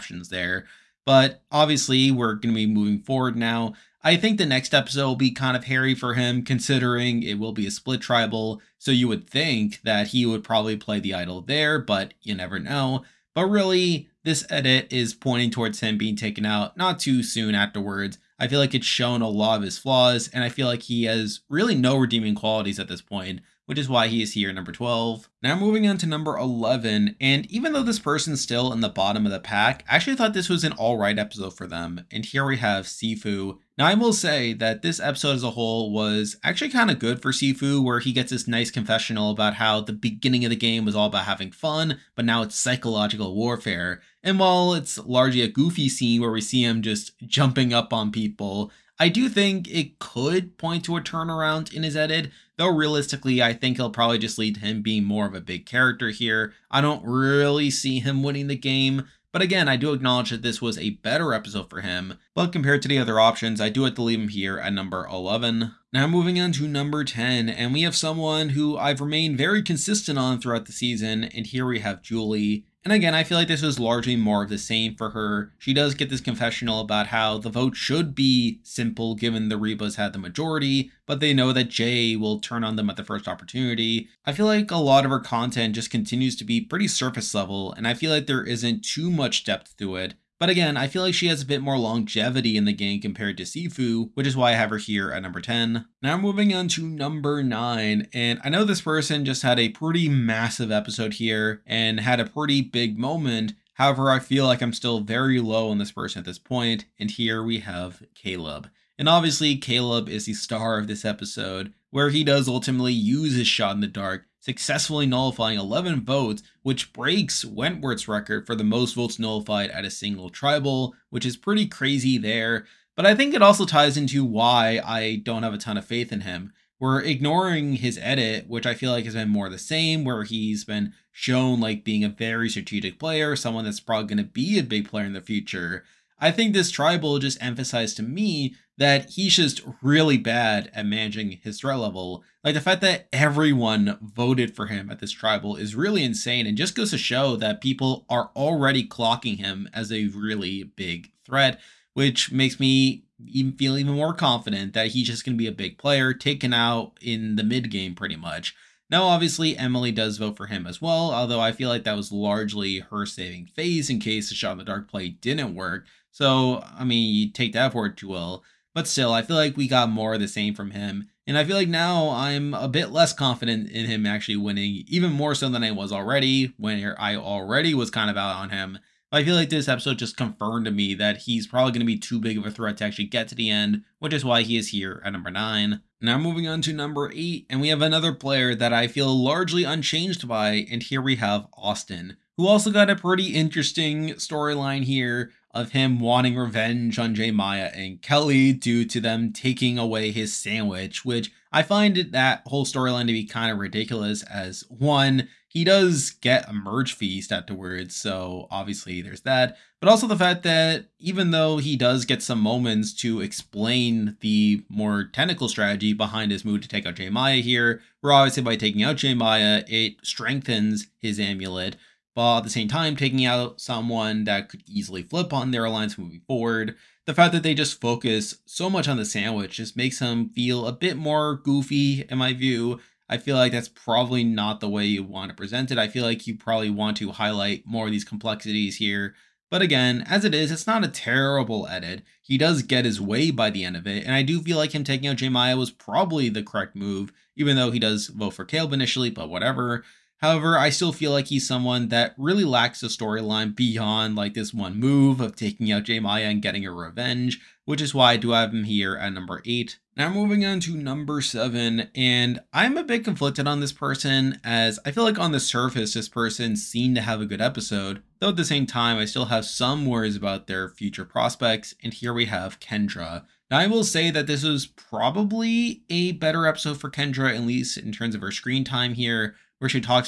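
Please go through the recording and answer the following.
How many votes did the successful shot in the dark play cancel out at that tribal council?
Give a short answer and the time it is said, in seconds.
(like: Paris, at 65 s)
11, at 115 s.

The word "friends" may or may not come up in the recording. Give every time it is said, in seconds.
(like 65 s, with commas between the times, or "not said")
not said.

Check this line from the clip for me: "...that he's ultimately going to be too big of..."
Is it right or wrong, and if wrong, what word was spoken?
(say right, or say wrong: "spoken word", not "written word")
wrong: "probably", not "ultimately".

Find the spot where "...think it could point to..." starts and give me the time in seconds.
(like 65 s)
49 s.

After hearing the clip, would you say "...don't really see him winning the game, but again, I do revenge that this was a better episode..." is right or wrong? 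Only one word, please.
wrong.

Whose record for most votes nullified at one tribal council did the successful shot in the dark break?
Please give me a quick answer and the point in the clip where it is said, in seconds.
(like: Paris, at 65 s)
Wentworth, at 117 s.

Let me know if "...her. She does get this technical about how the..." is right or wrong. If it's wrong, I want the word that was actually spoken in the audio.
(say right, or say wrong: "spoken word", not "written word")
wrong: "confessional", not "technical".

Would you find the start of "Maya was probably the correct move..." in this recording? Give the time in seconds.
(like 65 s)
245 s.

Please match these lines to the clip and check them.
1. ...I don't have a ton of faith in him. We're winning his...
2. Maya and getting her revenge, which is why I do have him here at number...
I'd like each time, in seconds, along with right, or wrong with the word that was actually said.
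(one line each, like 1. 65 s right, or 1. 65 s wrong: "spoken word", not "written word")
1. 124 s wrong: "ignoring", not "winning"
2. 255 s right.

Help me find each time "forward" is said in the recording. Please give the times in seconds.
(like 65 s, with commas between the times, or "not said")
2 s, 226 s.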